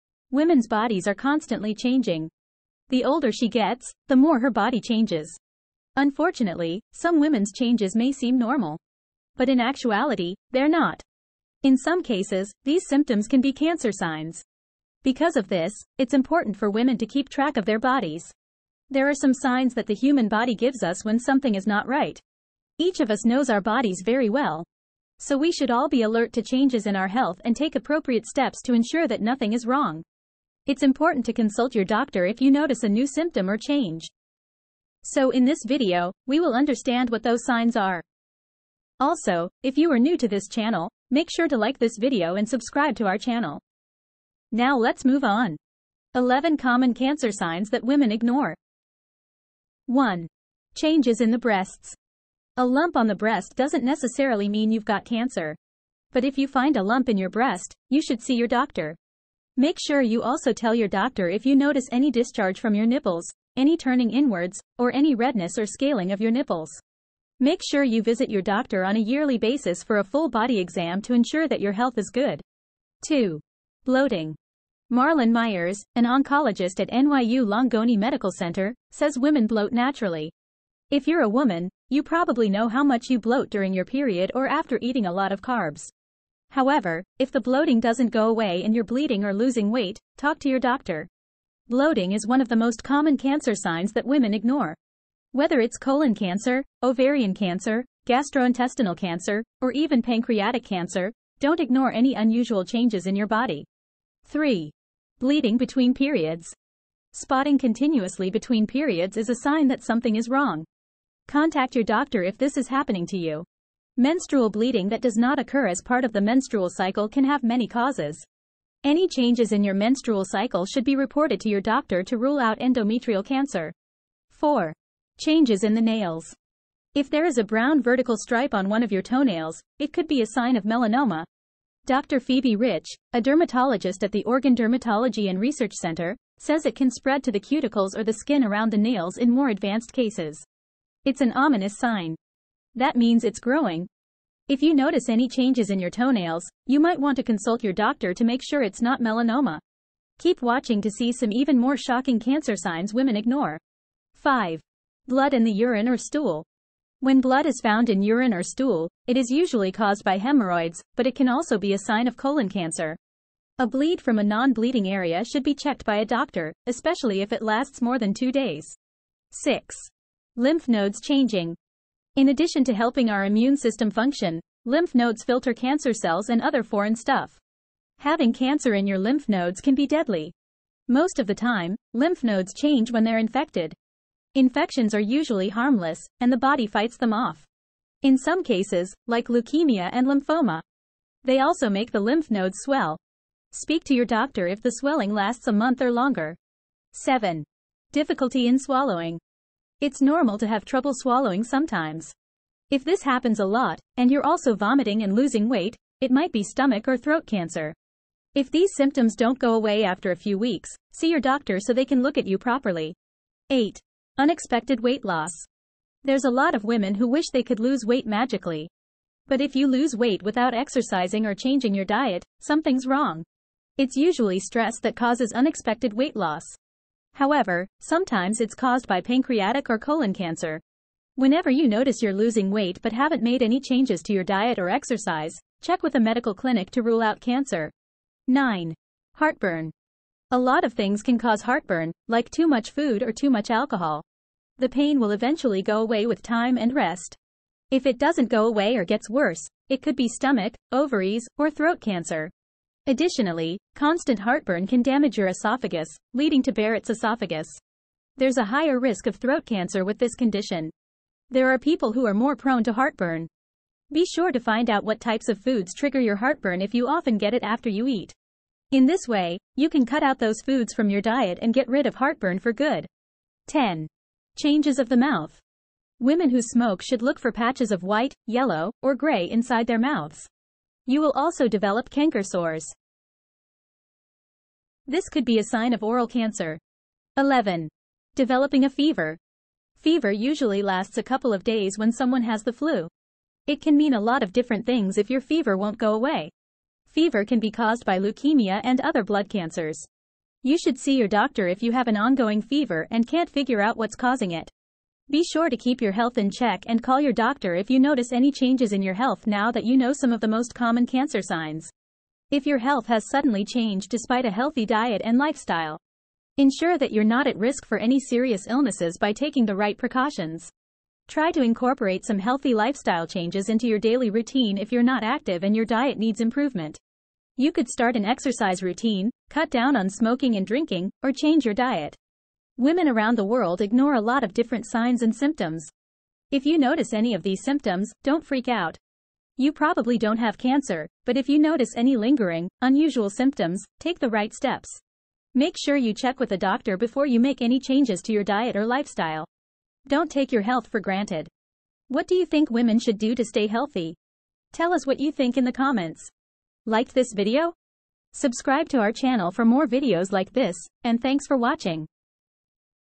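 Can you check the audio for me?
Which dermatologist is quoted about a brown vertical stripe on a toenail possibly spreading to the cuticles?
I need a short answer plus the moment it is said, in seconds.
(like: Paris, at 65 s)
Phoebe Rich, at 132 s.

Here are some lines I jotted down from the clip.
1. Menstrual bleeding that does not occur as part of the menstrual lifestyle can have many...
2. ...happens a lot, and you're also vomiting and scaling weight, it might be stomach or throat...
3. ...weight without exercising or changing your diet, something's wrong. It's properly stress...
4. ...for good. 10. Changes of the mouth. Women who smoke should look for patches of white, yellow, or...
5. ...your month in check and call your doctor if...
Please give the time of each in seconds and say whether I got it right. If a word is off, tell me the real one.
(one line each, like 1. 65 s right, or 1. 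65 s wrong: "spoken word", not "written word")
1. 114 s wrong: "cycle", not "lifestyle"
2. 203 s wrong: "losing", not "scaling"
3. 219 s wrong: "usually", not "properly"
4. 272 s right
5. 305 s wrong: "health", not "month".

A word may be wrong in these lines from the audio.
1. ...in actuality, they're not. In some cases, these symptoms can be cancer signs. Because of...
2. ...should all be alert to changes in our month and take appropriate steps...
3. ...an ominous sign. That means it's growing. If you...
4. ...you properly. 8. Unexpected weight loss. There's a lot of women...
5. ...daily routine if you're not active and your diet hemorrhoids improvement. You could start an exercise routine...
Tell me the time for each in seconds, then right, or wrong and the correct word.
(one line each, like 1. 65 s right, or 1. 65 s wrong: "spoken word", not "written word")
1. 9 s right
2. 25 s wrong: "health", not "month"
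3. 141 s right
4. 212 s right
5. 323 s wrong: "needs", not "hemorrhoids".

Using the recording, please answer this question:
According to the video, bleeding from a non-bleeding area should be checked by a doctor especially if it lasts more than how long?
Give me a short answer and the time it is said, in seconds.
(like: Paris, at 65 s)
2 days, at 168 s.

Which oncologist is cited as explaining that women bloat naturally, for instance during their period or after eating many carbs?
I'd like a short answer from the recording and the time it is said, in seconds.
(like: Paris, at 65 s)
Marlon Myers, at 74 s.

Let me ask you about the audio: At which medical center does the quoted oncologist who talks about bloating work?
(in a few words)
NYU Langone Medical Center.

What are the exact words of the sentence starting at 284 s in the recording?
This could be a sign of oral cancer.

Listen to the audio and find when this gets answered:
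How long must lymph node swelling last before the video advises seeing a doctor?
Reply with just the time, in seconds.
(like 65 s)
195 s.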